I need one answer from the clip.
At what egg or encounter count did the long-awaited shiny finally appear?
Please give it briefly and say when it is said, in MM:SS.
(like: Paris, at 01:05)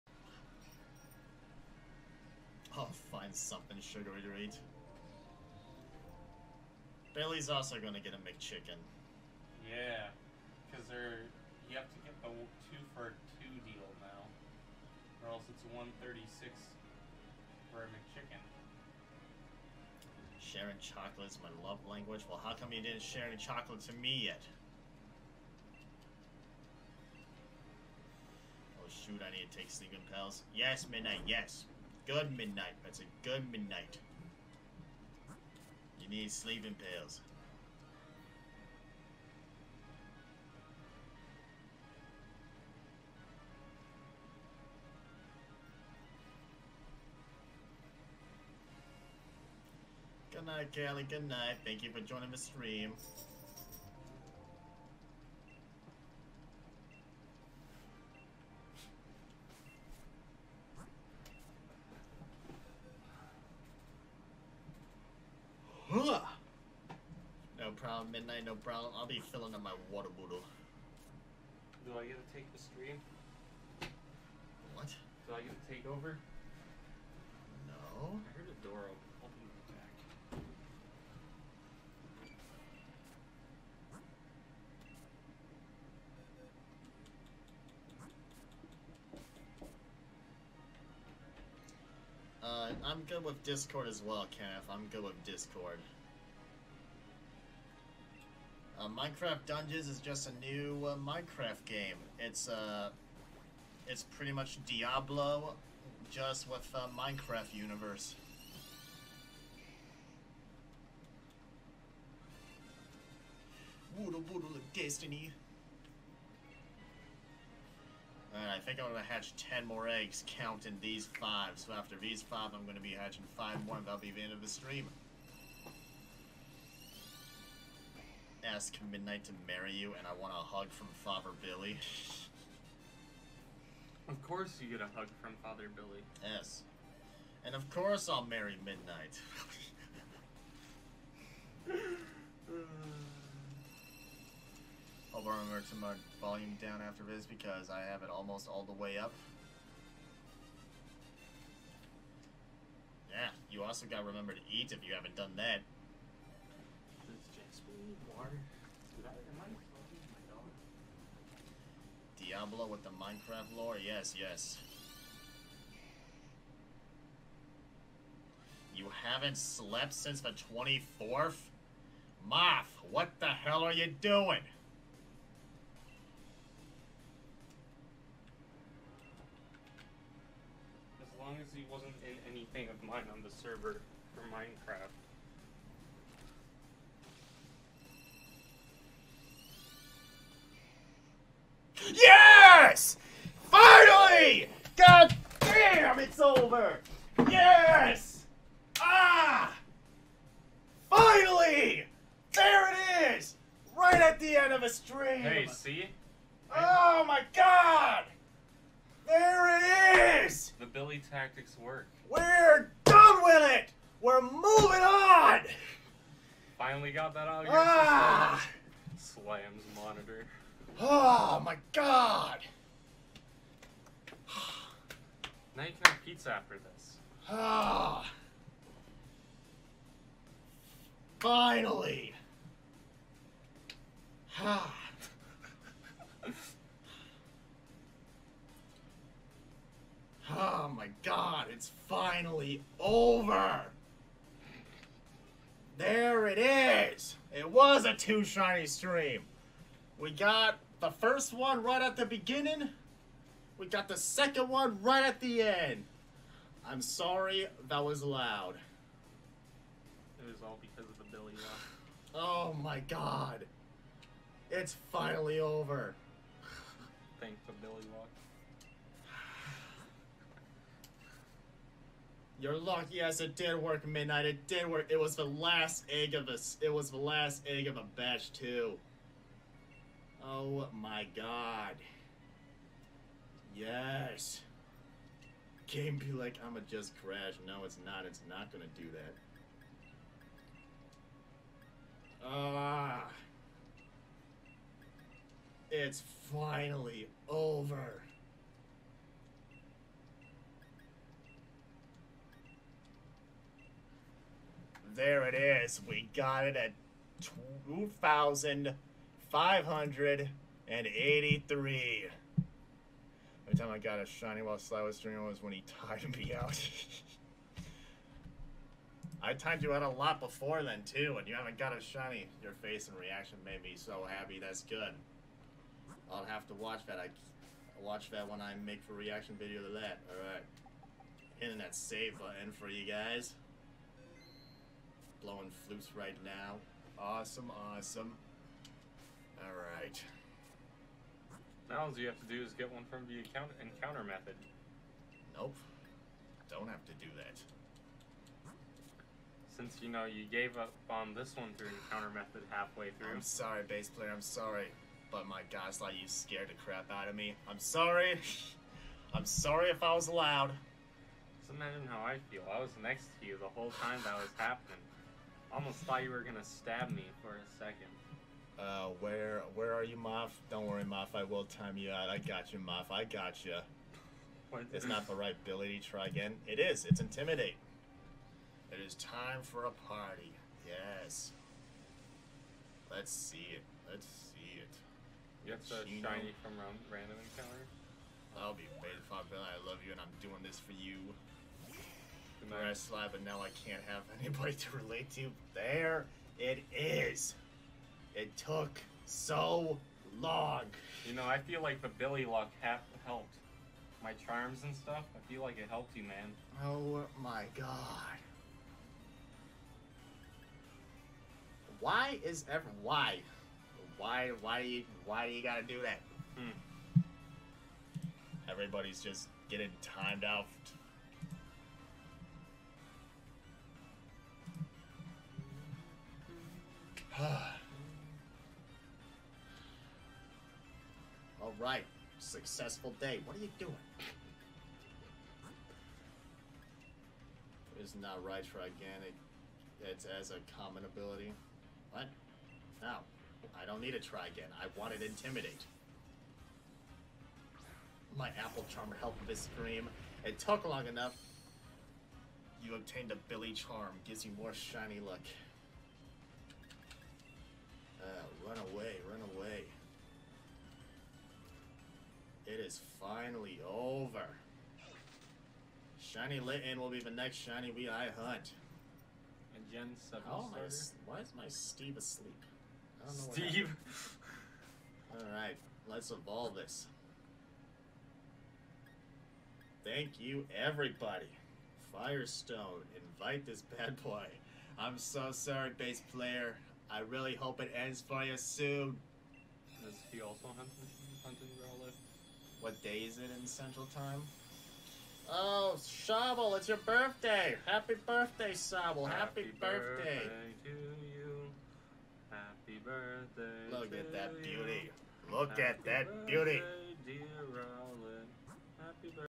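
2,583, at 05:07.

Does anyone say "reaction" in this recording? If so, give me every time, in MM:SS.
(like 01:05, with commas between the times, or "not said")
05:22, 05:28.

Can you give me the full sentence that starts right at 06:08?
Uh, where where are you, Moff?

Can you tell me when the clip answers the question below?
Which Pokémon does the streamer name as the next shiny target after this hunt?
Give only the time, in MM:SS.
07:46.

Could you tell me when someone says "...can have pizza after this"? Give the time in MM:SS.
03:45.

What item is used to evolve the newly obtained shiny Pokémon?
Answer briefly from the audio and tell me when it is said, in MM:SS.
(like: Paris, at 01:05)
Firestone, at 08:01.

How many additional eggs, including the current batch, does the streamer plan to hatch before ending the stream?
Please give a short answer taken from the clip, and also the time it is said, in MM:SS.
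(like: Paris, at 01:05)
10, at 01:59.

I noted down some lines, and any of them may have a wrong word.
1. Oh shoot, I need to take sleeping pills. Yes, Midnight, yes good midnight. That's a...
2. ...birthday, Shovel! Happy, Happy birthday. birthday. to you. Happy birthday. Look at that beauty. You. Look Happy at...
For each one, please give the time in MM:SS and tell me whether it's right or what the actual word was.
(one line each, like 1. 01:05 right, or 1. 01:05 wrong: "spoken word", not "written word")
1. 00:28 right
2. 08:18 right.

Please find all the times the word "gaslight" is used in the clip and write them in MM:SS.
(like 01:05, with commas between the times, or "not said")
05:55.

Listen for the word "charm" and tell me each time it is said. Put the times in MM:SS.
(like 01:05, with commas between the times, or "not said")
06:44, 07:28, 07:33.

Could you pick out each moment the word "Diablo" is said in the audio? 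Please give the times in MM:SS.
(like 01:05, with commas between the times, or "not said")
01:44, 02:42.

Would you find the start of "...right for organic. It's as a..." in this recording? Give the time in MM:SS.
07:18.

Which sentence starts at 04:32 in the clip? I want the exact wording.
You're lucky as it did work, Midnight.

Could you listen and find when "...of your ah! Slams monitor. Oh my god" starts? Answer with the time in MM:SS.
03:37.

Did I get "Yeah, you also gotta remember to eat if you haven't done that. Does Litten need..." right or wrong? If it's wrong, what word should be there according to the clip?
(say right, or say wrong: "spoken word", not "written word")
wrong: "Jasper", not "Litten".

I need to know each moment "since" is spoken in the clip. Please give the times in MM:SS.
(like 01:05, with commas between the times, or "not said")
02:49, 05:49.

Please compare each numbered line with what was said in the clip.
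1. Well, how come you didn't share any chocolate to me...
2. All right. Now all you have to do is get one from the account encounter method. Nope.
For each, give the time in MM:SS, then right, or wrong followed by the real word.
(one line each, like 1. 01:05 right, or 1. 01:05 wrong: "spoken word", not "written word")
1. 00:22 right
2. 05:39 right.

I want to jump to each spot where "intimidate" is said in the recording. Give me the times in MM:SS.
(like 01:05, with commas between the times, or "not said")
06:17, 07:25.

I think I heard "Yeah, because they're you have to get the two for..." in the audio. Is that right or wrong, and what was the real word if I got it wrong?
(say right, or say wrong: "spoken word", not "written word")
right.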